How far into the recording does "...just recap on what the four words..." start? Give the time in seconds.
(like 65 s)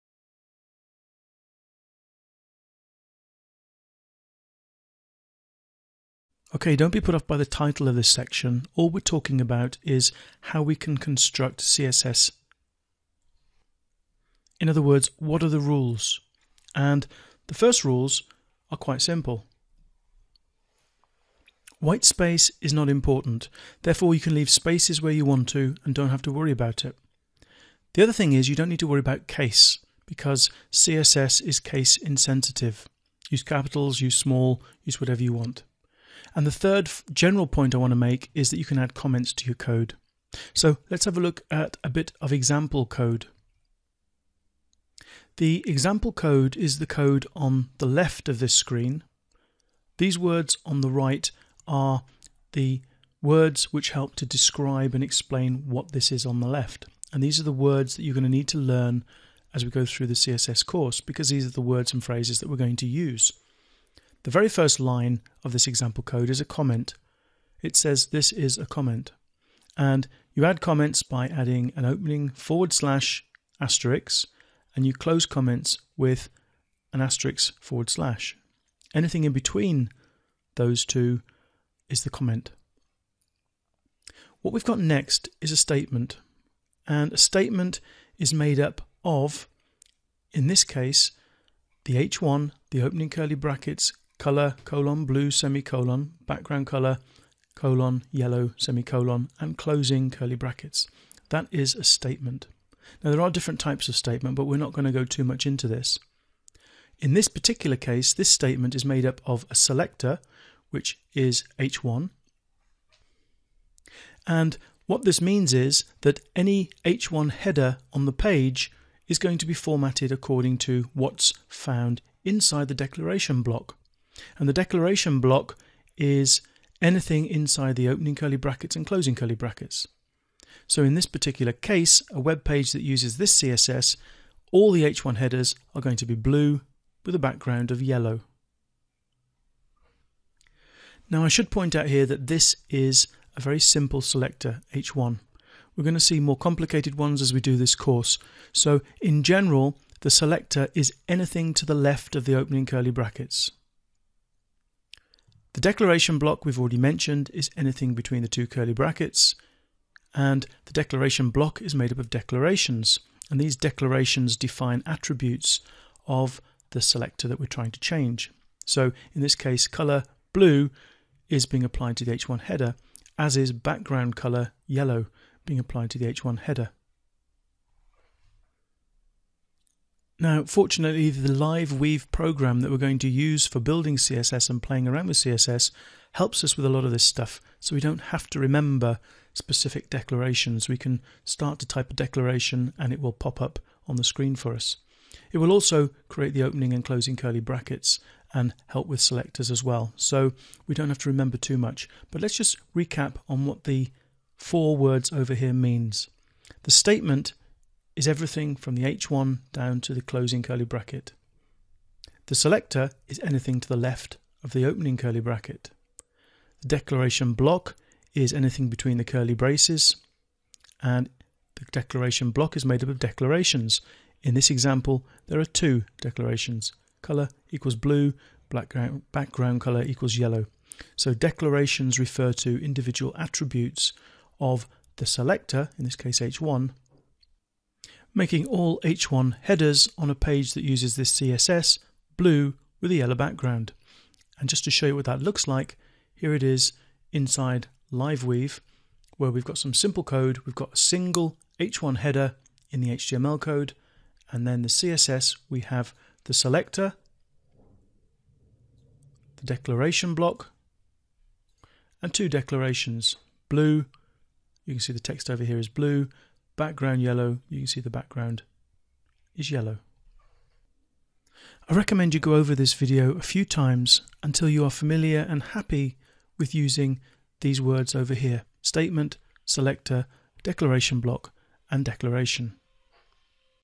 202 s.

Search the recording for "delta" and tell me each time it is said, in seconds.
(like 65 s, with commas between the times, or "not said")
not said.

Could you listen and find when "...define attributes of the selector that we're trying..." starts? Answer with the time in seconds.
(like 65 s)
164 s.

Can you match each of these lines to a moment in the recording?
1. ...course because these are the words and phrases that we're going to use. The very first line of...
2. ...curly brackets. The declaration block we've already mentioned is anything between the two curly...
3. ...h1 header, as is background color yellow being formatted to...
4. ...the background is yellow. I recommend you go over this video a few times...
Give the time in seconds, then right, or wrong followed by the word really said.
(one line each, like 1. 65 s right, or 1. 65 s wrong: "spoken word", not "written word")
1. 60 s right
2. 152 s right
3. 172 s wrong: "applied", not "formatted"
4. 267 s right.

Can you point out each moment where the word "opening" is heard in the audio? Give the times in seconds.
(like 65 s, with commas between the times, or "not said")
71 s, 92 s, 127 s, 152 s, 196 s, 214 s.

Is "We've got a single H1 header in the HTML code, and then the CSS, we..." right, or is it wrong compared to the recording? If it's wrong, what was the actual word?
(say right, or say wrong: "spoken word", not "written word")
right.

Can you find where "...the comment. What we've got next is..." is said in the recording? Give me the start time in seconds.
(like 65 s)
82 s.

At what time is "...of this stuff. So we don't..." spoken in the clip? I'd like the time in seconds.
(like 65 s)
186 s.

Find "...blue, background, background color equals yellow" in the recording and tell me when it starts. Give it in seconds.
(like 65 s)
227 s.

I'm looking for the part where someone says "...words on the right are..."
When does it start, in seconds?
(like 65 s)
50 s.